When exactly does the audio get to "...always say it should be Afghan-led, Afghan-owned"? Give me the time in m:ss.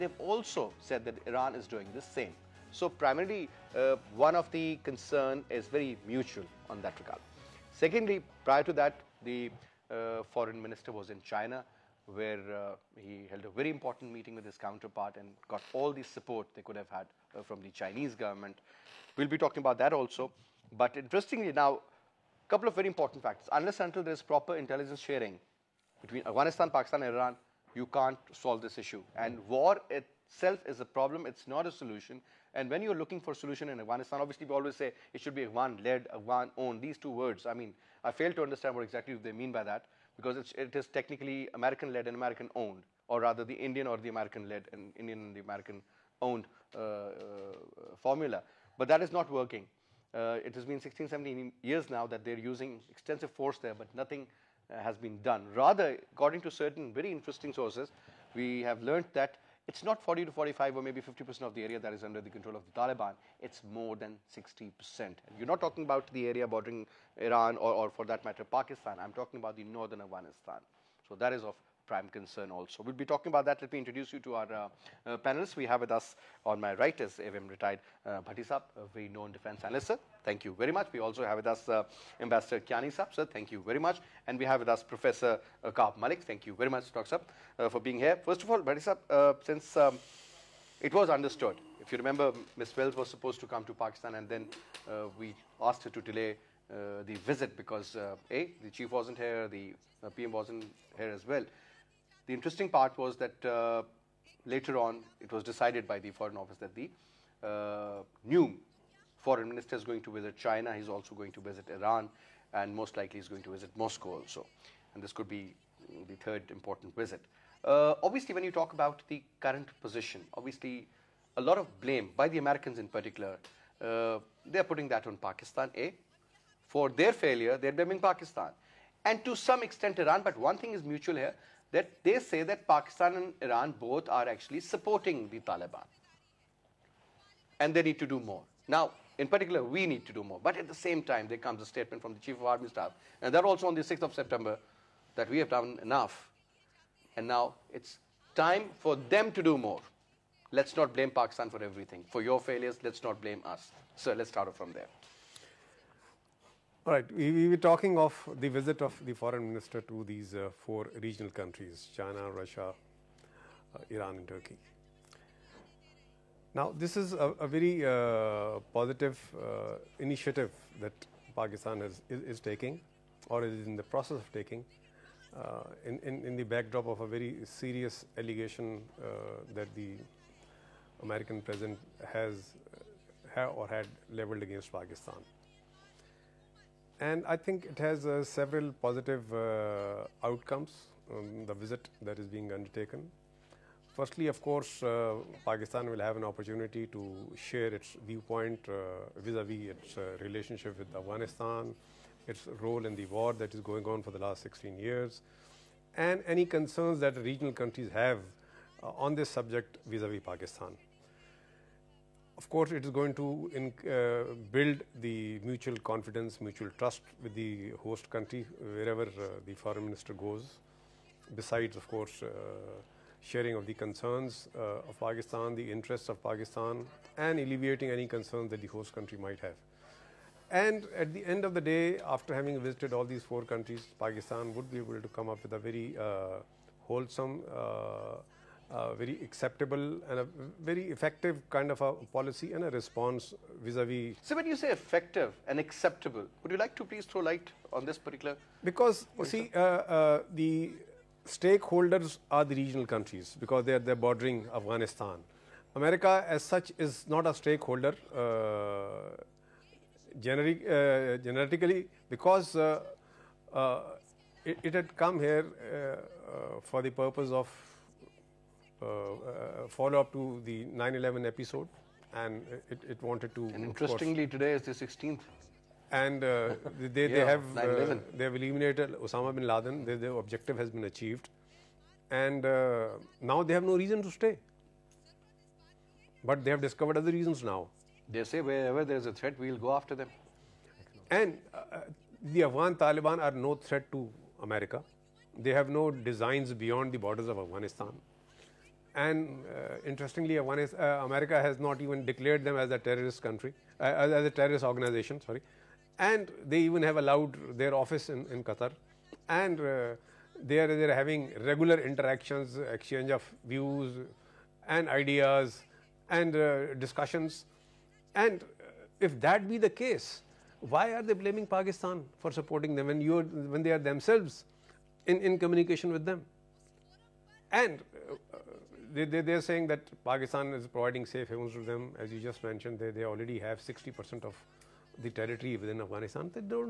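0:34.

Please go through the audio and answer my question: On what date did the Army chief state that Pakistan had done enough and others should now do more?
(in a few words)
6th of September.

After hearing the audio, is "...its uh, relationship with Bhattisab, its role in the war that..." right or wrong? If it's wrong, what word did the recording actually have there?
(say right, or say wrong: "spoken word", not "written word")
wrong: "Afghanistan", not "Bhattisab".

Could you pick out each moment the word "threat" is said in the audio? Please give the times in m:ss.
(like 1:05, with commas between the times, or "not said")
4:49, 4:53.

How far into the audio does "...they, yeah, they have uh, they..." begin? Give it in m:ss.
4:36.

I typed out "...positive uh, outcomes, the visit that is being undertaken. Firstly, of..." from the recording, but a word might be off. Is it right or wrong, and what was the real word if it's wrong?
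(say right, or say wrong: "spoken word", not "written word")
right.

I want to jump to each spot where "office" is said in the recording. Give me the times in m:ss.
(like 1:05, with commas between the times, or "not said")
1:46, 5:07.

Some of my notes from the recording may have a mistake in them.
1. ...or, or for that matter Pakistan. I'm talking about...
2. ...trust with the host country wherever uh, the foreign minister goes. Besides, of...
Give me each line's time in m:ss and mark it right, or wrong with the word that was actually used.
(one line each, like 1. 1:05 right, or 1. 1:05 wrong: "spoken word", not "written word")
1. 1:07 right
2. 3:36 right.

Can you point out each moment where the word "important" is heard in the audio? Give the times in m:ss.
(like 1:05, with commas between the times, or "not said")
0:13, 0:22, 1:56.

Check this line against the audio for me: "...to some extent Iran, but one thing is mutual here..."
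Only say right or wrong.
right.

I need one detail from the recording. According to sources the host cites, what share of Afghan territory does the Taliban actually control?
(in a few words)
More than 60%.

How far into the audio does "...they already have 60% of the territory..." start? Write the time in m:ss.
5:32.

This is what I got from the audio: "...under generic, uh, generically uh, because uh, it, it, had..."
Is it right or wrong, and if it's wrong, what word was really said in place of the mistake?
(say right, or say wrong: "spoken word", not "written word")
wrong: "stakeholder", not "under".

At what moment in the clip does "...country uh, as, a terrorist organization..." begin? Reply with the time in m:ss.
5:03.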